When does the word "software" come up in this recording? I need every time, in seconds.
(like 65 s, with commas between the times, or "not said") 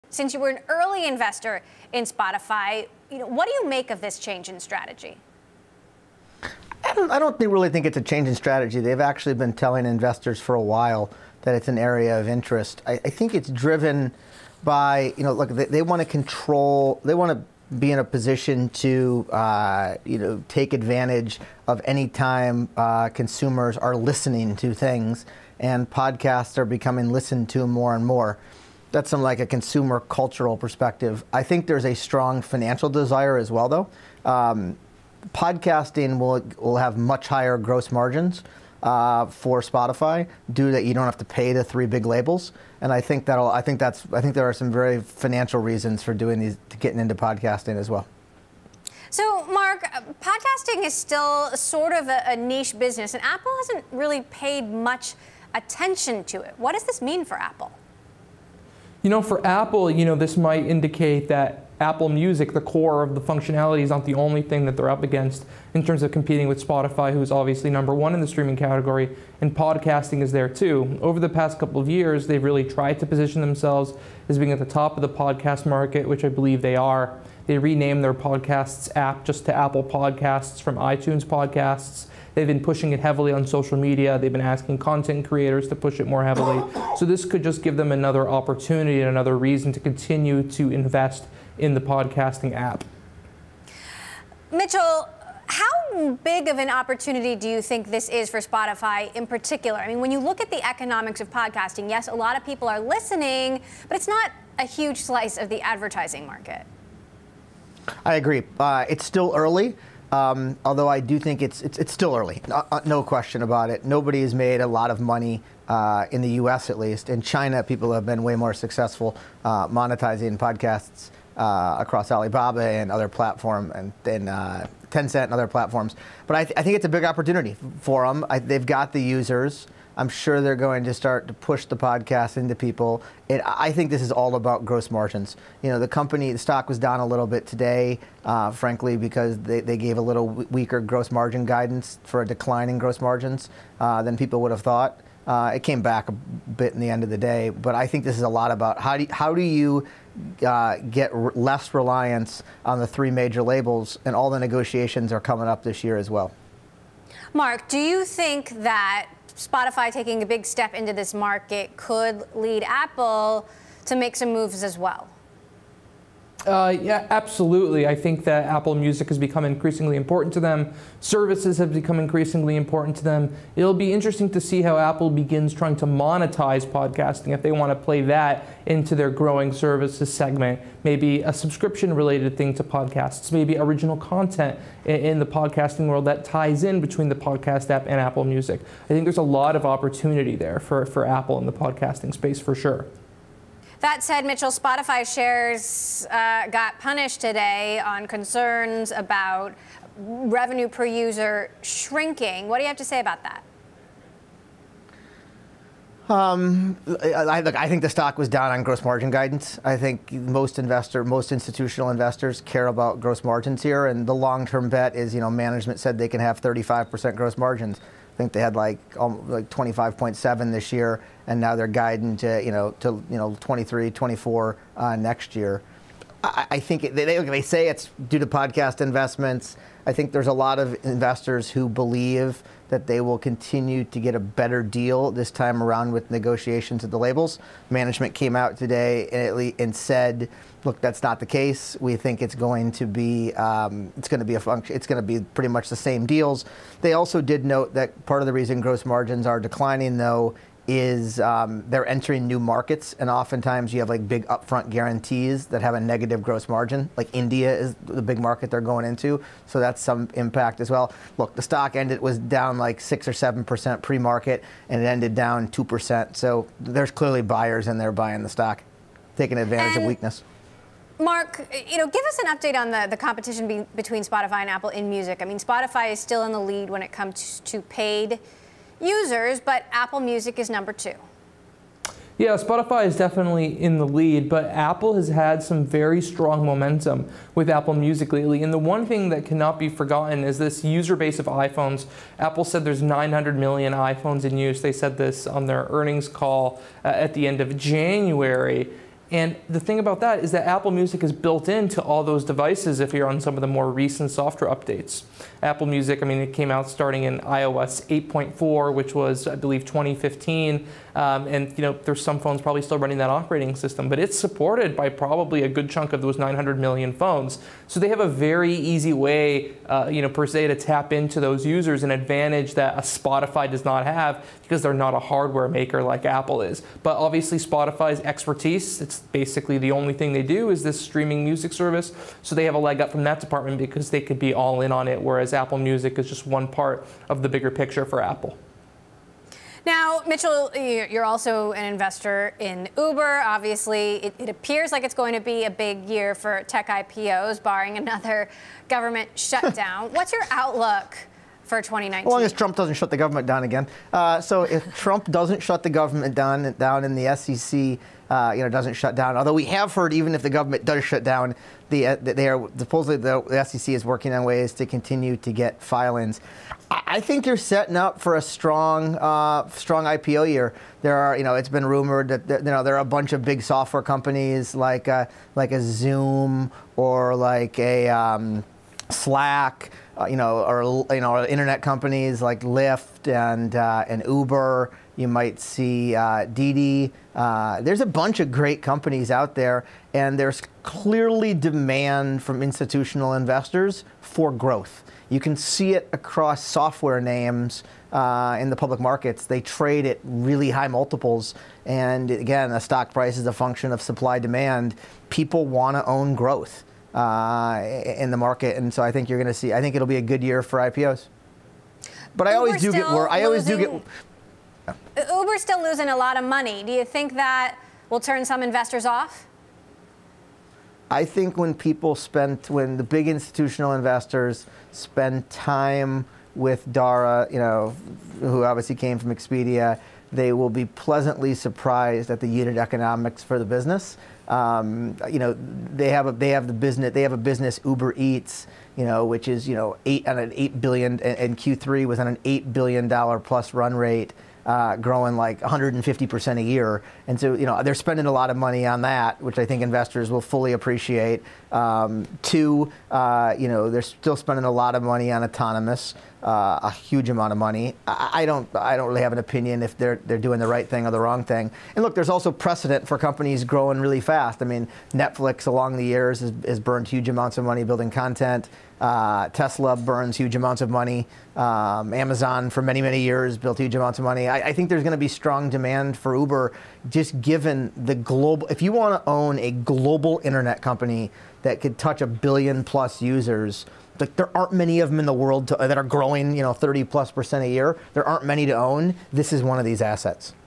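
304 s, 373 s, 396 s.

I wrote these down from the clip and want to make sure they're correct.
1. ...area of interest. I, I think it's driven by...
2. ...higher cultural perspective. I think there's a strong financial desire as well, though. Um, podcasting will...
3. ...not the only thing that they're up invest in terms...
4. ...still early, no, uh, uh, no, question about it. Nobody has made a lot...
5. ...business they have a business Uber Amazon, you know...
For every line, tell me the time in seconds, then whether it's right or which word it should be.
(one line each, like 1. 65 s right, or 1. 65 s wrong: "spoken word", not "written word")
1. 11 s right
2. 29 s wrong: "consumer", not "higher"
3. 63 s wrong: "against", not "invest"
4. 111 s right
5. 436 s wrong: "Eats", not "Amazon".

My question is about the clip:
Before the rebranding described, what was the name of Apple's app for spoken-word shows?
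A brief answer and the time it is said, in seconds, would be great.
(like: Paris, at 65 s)
iTunes Podcasts, at 80 s.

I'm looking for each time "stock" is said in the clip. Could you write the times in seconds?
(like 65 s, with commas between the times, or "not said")
136 s, 207 s, 261 s, 268 s, 402 s.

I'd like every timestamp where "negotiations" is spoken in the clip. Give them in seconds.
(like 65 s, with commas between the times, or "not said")
154 s, 236 s.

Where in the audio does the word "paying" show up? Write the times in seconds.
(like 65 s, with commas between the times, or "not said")
not said.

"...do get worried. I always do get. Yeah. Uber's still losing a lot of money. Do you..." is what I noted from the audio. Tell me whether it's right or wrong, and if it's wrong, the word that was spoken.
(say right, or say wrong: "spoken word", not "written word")
right.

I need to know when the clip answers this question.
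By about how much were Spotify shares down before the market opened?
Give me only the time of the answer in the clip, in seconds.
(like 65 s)
262 s.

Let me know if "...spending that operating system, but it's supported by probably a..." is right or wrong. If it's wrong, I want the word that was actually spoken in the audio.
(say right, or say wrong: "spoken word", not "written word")
wrong: "running", not "spending".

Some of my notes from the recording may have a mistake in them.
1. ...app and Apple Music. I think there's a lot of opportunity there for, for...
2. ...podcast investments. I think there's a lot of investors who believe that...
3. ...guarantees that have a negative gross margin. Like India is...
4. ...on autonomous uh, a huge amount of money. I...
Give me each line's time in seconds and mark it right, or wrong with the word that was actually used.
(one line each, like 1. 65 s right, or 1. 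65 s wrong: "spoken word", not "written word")
1. 187 s right
2. 228 s right
3. 254 s right
4. 455 s right.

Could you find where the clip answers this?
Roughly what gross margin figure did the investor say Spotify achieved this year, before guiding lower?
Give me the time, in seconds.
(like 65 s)
219 s.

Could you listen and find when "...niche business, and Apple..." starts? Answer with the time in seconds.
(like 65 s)
52 s.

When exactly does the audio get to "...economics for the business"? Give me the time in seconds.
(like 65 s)
432 s.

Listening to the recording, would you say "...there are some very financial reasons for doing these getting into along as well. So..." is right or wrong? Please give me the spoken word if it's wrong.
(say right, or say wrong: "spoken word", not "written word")
wrong: "podcasting", not "along".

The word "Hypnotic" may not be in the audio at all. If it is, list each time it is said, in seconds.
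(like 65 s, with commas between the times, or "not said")
not said.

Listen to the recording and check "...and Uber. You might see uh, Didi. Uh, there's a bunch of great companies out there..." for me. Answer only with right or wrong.
right.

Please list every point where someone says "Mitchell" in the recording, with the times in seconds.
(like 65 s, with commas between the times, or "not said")
94 s, 194 s, 340 s.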